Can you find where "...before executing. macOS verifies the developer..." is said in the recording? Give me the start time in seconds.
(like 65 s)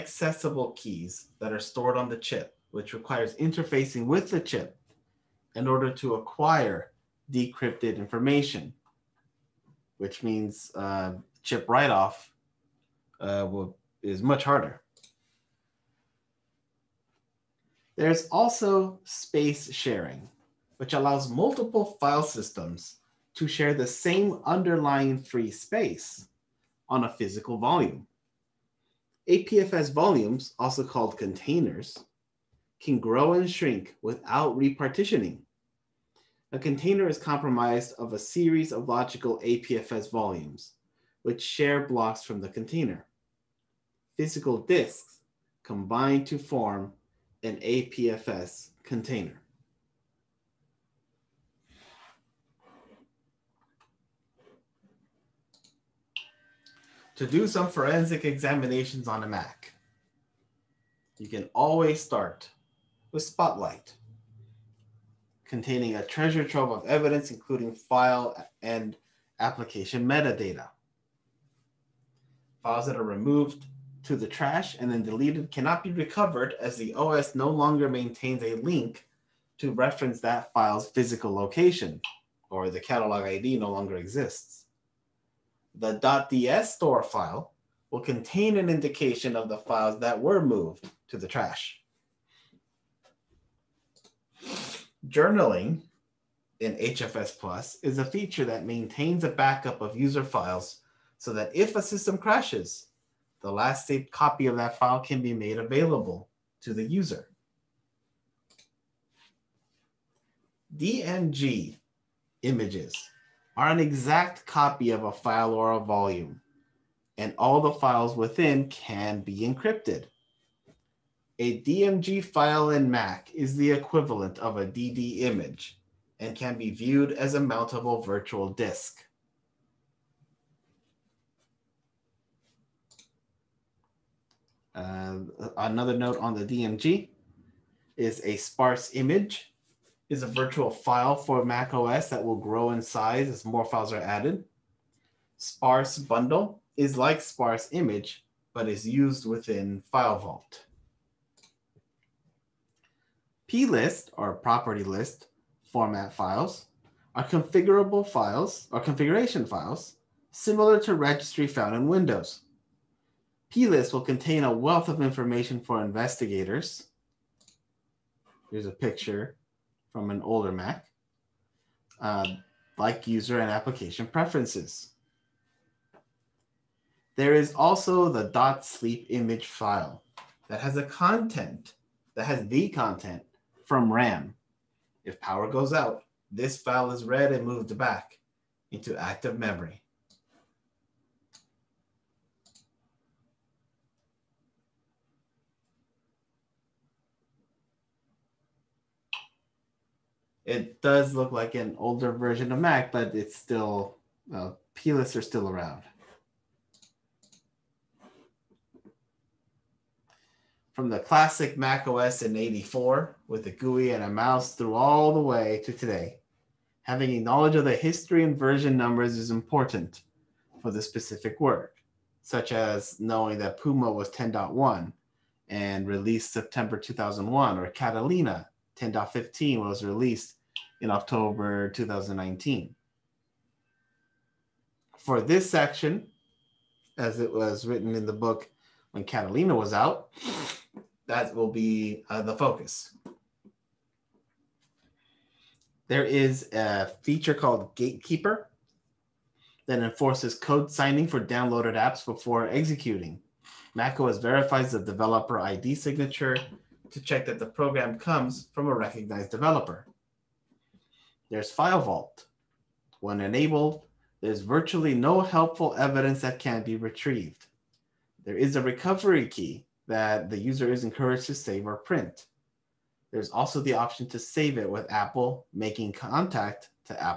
252 s.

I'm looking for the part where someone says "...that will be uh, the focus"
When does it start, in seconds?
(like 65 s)
241 s.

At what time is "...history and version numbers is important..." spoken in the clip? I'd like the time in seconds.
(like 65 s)
217 s.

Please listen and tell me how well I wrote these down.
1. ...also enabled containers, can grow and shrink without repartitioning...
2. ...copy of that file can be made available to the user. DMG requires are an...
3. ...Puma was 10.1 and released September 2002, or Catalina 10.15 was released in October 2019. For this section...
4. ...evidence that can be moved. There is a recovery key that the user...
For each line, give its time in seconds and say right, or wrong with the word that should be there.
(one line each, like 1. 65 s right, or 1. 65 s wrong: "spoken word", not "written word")
1. 30 s wrong: "called", not "enabled"
2. 104 s wrong: "images", not "requires"
3. 223 s wrong: "2001", not "2002"
4. 265 s wrong: "retrieved", not "moved".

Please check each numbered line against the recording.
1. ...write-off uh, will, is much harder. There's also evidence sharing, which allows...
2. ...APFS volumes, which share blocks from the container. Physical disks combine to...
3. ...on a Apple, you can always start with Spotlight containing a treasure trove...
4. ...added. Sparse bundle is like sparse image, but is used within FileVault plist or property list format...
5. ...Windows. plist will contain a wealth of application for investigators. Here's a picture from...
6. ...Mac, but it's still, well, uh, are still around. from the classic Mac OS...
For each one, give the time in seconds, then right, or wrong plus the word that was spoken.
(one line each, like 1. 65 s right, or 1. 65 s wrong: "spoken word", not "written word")
1. 11 s wrong: "space", not "evidence"
2. 39 s right
3. 59 s wrong: "Mac", not "Apple"
4. 143 s right
5. 161 s wrong: "information", not "application"
6. 202 s right.